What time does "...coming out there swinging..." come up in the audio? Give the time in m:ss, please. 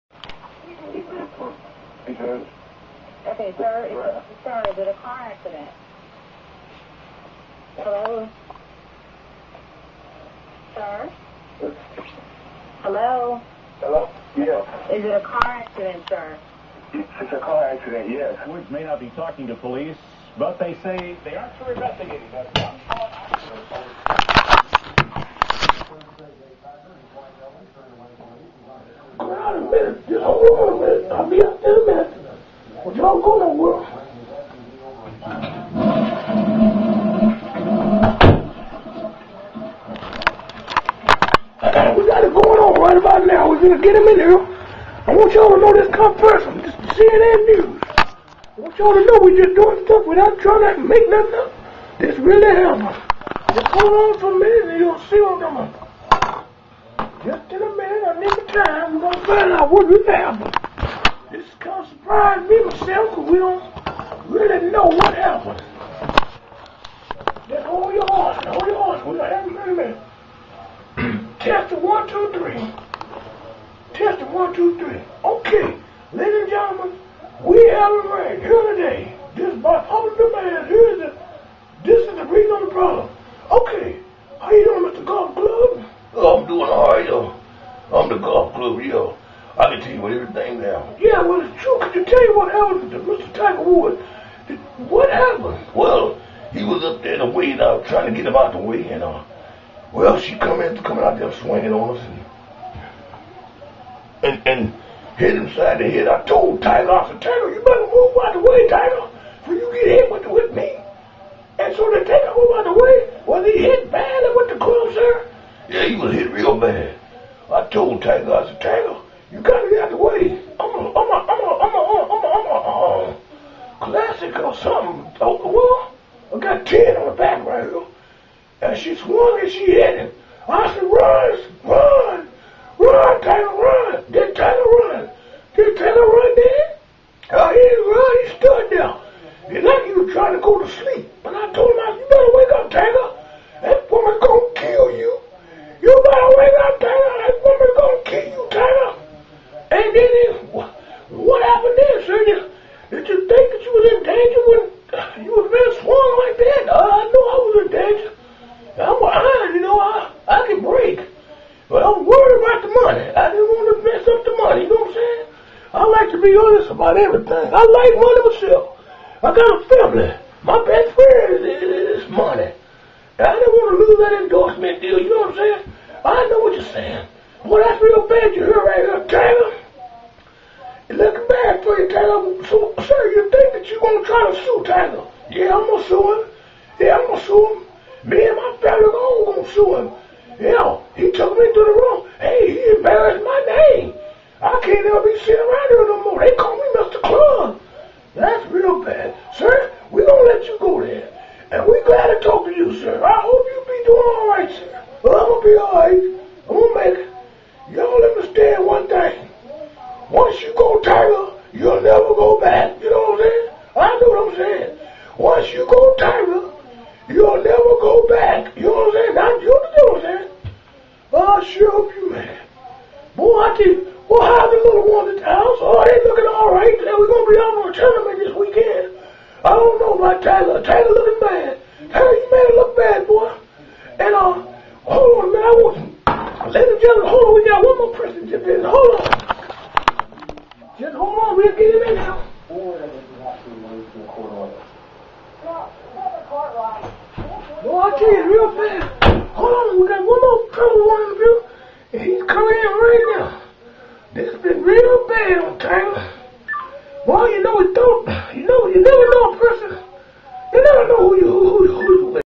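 1:40.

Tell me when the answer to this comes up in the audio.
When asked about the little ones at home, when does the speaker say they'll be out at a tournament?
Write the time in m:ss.
3:48.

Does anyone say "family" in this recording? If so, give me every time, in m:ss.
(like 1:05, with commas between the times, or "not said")
2:49, 3:08.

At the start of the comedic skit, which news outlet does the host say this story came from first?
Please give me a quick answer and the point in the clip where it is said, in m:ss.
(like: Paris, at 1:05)
CNN, at 0:46.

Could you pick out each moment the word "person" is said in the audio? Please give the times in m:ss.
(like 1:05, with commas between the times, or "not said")
3:57, 4:19.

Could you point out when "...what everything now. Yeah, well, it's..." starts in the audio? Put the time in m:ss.
1:30.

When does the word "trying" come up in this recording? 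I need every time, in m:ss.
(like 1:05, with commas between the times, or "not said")
0:50, 1:37, 2:20.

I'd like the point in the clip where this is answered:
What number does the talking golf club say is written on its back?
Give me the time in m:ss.
2:06.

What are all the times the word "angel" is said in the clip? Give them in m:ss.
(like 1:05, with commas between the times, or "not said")
not said.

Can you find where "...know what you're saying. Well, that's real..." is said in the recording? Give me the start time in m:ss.
2:56.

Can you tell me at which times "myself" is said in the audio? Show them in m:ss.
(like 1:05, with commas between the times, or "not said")
1:02, 2:48.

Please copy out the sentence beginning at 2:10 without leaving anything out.
I said, run, run, run, Taylor, run.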